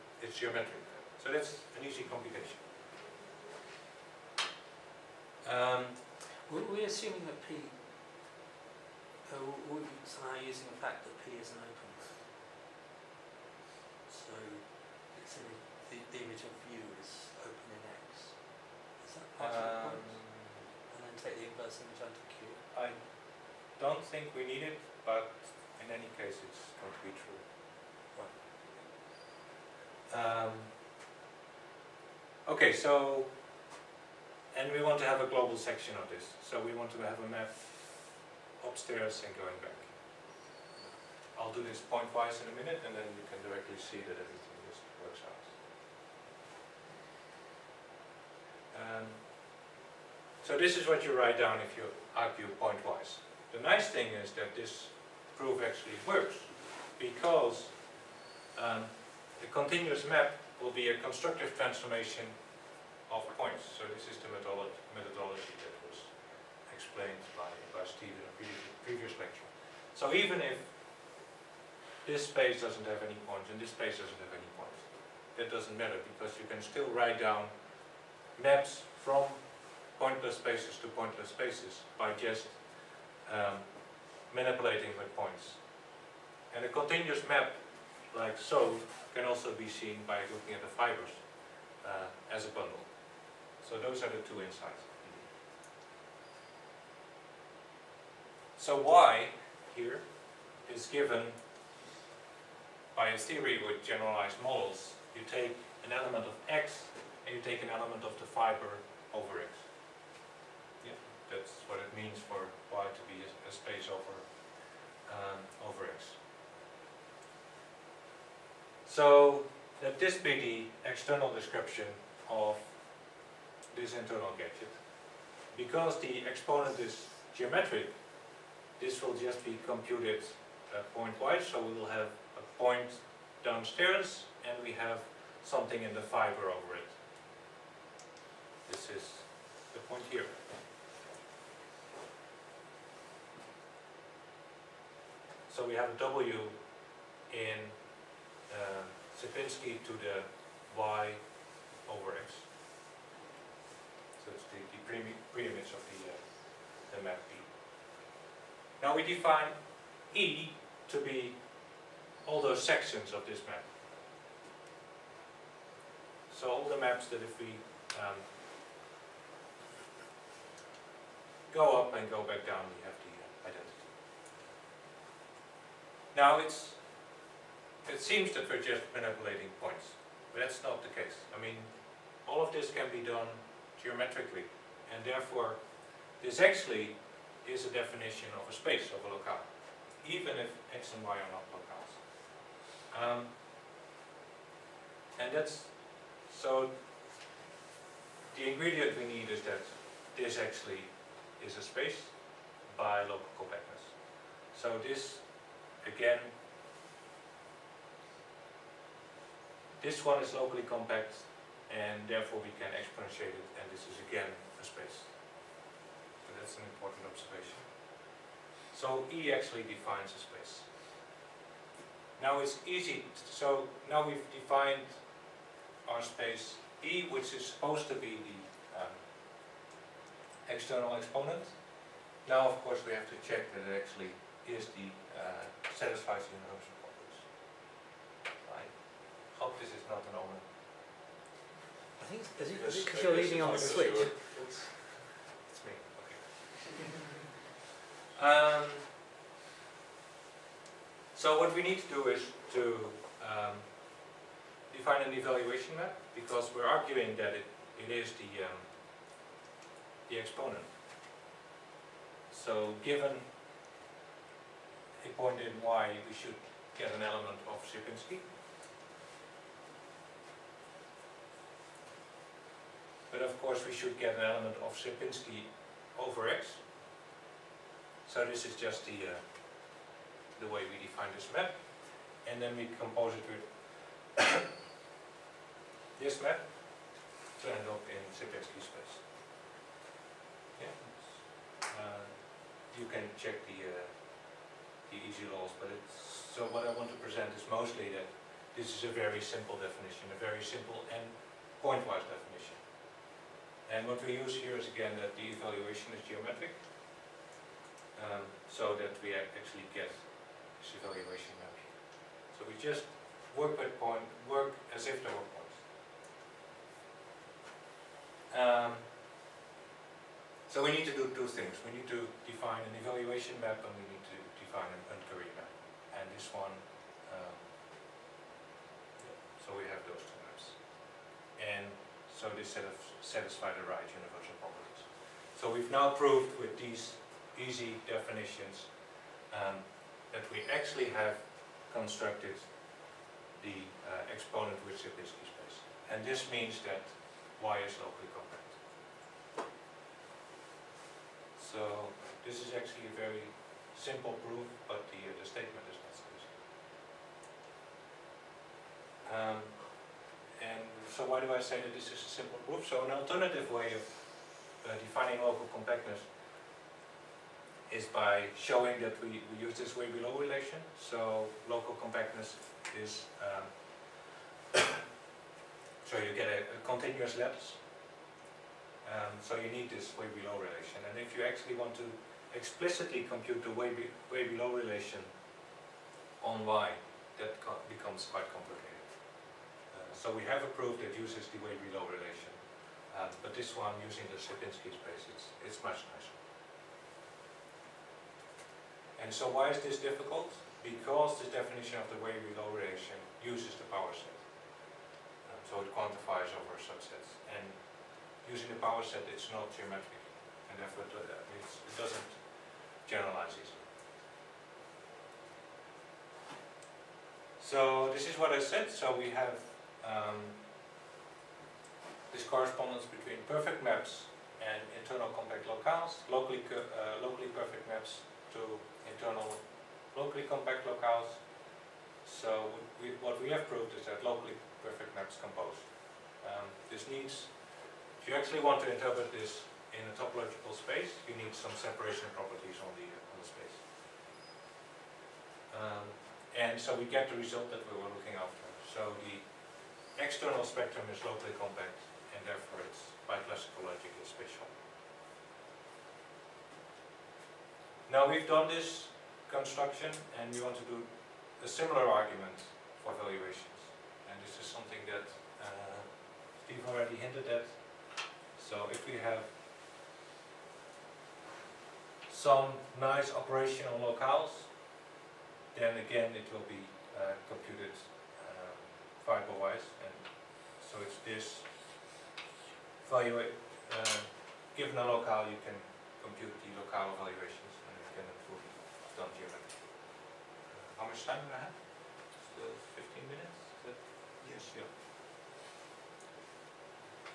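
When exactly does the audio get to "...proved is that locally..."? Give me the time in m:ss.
7:13.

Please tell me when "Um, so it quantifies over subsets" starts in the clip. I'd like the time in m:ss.
6:45.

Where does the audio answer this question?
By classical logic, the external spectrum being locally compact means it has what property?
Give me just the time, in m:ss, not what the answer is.
7:34.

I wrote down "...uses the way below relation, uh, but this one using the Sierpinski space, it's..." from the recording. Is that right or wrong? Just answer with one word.
right.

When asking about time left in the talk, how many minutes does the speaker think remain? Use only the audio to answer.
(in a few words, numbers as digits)
15.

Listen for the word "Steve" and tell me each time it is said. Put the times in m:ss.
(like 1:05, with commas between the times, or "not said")
1:07, 7:46.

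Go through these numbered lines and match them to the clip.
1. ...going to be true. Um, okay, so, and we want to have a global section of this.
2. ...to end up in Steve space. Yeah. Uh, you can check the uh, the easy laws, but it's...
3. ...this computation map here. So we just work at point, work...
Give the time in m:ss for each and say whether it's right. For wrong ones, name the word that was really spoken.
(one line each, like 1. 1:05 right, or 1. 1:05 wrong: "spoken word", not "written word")
1. 0:26 right
2. 4:47 wrong: "Sierpinski", not "Steve"
3. 5:10 wrong: "evaluation", not "computation".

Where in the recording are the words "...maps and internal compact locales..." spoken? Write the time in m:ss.
7:03.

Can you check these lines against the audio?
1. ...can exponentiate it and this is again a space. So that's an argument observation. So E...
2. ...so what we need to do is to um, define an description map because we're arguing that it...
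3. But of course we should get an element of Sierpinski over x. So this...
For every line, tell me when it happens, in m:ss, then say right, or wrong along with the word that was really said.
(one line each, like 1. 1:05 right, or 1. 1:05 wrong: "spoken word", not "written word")
1. 3:32 wrong: "important", not "argument"
2. 4:11 wrong: "evaluation", not "description"
3. 4:33 right.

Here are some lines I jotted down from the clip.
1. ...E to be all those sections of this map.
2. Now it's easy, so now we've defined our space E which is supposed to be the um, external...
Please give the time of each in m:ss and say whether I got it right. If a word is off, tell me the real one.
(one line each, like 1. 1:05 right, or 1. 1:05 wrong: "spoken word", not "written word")
1. 2:40 right
2. 3:42 right.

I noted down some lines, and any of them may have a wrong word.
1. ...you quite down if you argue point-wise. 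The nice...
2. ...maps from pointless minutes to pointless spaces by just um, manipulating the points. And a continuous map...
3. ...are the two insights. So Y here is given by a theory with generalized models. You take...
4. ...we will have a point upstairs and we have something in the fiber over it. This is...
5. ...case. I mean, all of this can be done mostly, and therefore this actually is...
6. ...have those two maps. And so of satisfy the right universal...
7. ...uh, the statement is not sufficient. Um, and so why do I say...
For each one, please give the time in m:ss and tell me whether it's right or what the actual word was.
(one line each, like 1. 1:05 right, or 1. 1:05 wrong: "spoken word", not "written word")
1. 0:51 wrong: "write", not "quite"
2. 1:18 wrong: "spaces", not "minutes"
3. 1:34 right
4. 2:11 wrong: "downstairs", not "upstairs"
5. 3:00 wrong: "geometrically", not "mostly"
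6. 5:29 right
7. 5:54 right.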